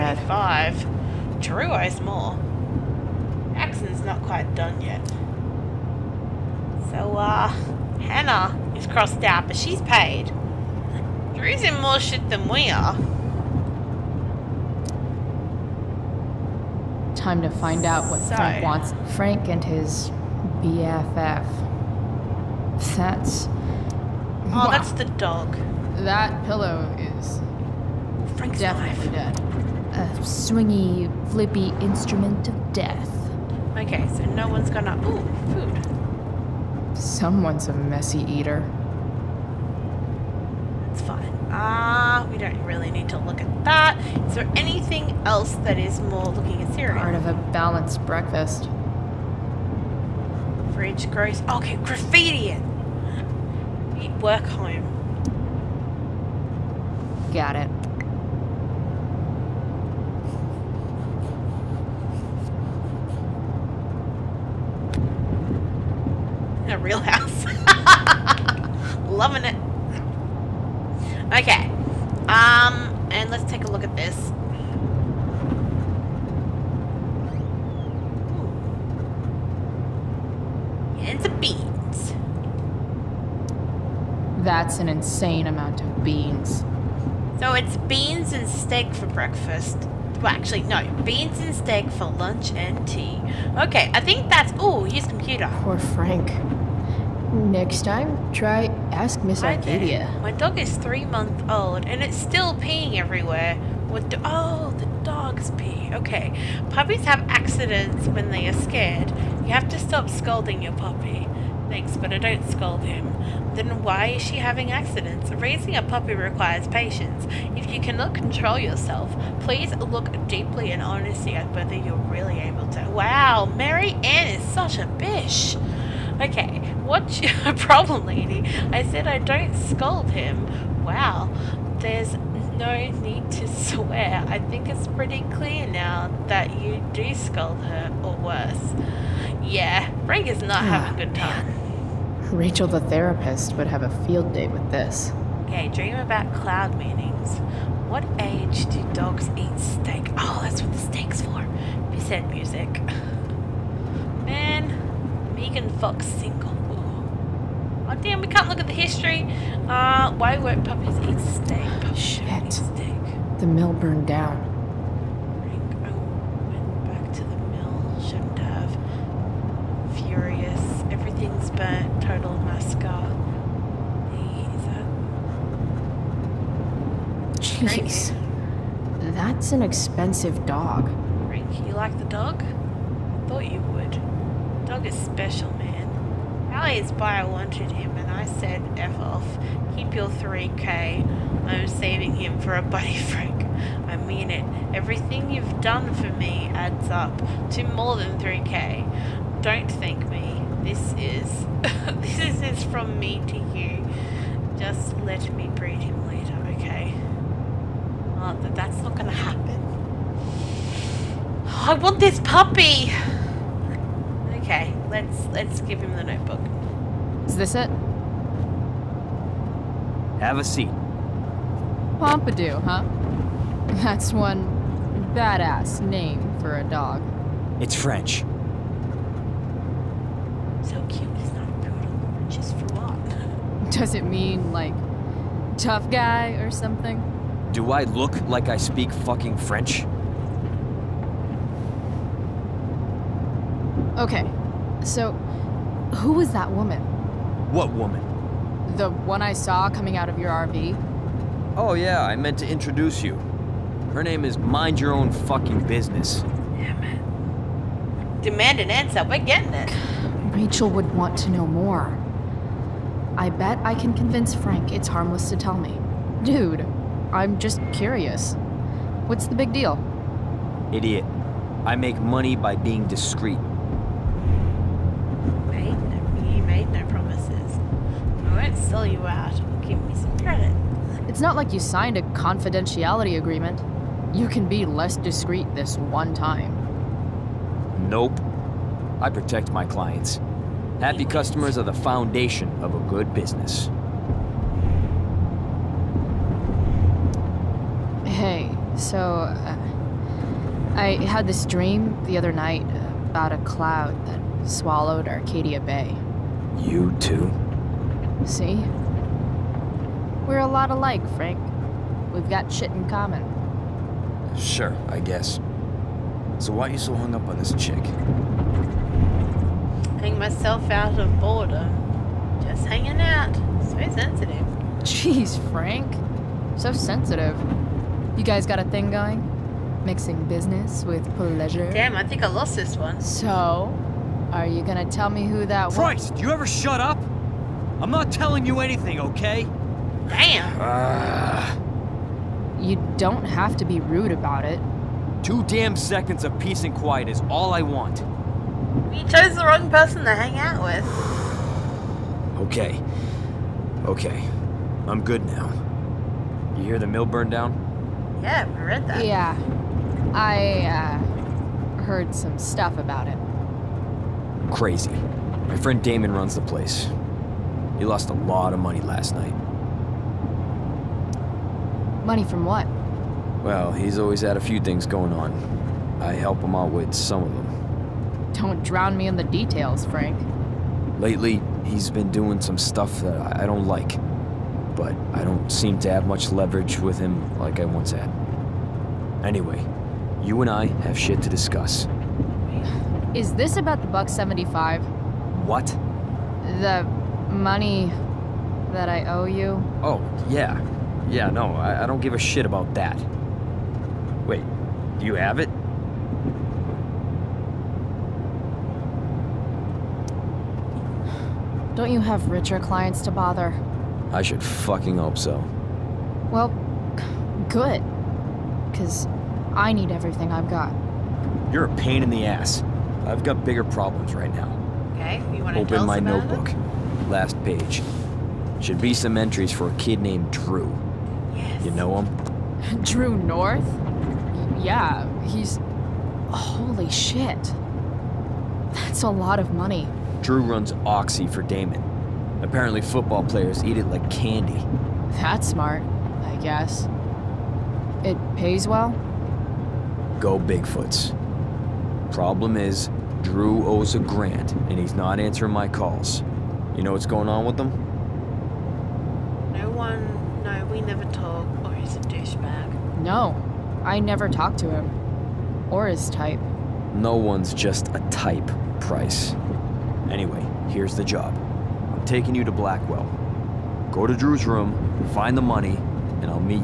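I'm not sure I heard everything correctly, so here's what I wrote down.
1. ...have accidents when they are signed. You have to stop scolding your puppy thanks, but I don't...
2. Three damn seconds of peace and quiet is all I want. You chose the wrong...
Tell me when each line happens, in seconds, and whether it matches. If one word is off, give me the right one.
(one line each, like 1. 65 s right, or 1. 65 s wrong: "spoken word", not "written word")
1. 107 s wrong: "scared", not "signed"
2. 345 s wrong: "Two", not "Three".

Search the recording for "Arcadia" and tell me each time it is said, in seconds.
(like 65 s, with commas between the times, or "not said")
99 s, 305 s.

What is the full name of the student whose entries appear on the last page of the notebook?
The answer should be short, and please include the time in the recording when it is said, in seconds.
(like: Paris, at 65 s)
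Drew North, at 432 s.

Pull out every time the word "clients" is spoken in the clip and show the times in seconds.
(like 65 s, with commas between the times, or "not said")
289 s, 412 s.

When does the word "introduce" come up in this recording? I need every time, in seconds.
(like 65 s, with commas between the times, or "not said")
252 s.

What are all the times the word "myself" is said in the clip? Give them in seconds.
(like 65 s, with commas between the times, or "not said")
320 s.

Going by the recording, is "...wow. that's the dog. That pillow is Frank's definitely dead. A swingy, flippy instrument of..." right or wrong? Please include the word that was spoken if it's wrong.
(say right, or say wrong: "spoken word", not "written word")
right.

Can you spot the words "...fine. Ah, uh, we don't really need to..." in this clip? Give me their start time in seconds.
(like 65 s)
41 s.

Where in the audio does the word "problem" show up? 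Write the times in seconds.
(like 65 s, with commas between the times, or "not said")
127 s, 423 s, 452 s.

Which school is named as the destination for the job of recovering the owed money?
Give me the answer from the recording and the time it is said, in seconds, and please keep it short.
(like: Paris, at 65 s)
Blackwell, at 472 s.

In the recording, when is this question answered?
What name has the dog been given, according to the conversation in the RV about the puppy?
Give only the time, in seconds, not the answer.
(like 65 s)
221 s.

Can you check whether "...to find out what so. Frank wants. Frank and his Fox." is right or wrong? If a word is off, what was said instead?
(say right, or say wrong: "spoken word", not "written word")
wrong: "BFF", not "Fox".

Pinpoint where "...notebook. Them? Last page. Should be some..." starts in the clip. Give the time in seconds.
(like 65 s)
425 s.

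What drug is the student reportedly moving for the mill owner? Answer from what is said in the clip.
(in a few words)
Oxy.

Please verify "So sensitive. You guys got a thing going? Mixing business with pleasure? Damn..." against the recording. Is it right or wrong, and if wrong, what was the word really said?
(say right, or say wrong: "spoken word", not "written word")
right.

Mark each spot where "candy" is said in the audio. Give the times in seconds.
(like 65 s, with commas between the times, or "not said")
444 s.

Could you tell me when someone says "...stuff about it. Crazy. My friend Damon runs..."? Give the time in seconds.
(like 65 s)
362 s.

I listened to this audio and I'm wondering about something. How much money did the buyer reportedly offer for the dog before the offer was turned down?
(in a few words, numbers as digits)
3K.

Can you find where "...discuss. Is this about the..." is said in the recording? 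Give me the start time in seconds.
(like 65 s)
391 s.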